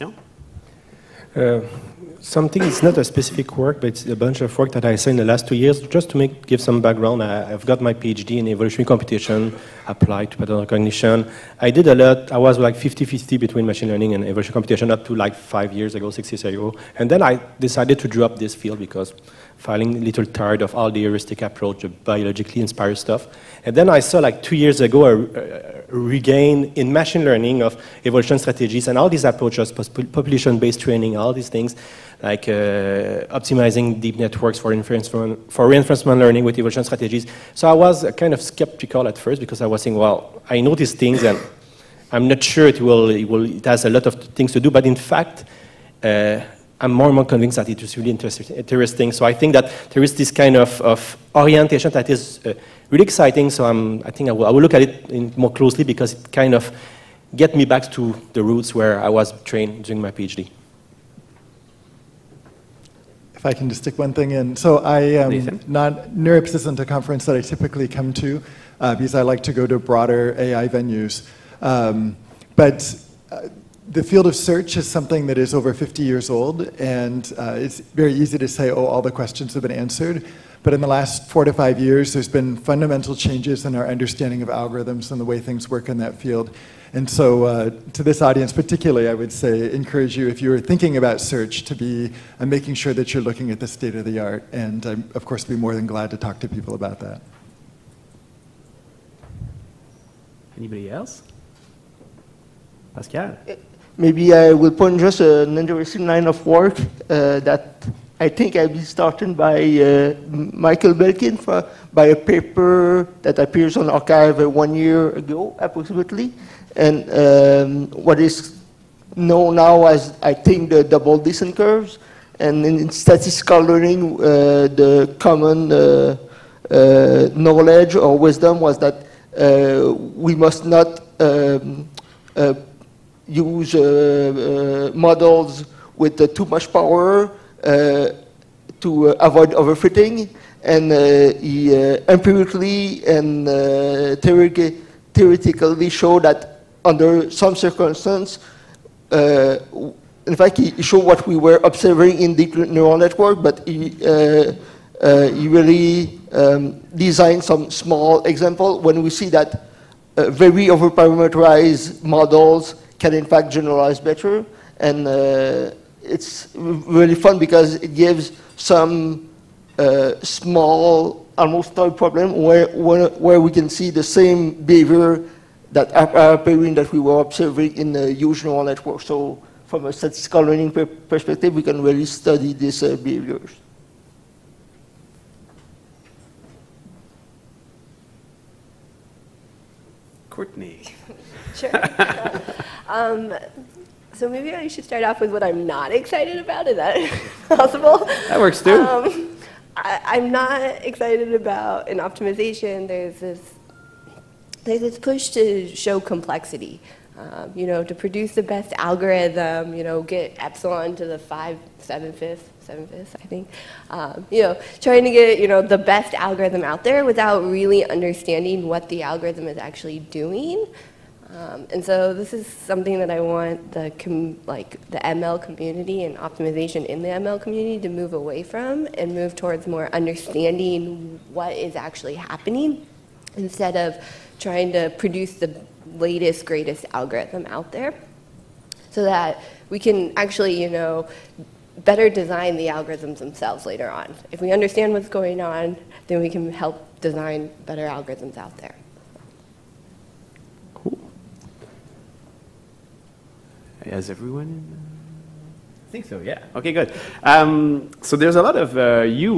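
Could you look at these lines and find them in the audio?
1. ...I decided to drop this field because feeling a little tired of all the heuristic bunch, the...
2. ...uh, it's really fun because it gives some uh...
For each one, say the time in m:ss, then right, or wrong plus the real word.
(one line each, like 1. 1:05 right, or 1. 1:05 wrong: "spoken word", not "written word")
1. 0:17 wrong: "approach", not "bunch"
2. 2:45 right.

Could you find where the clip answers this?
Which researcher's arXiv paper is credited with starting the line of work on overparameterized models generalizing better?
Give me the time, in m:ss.
1:50.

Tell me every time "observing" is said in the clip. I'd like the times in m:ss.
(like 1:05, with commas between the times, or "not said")
2:31, 2:57.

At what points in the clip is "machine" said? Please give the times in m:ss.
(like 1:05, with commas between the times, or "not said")
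0:13, 0:26.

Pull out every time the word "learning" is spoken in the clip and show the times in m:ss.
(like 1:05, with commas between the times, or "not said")
0:13, 0:27, 0:36, 2:03, 3:00.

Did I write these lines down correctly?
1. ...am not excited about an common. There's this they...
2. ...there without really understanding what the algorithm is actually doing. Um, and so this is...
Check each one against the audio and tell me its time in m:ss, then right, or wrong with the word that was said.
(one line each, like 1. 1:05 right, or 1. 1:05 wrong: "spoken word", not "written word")
1. 3:20 wrong: "optimization", not "common"
2. 3:36 right.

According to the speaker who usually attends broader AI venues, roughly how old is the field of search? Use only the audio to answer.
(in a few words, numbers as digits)
Over 50 years.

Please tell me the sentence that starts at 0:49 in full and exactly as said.
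So I think that there is this kind of, of orientation that is uh, really exciting.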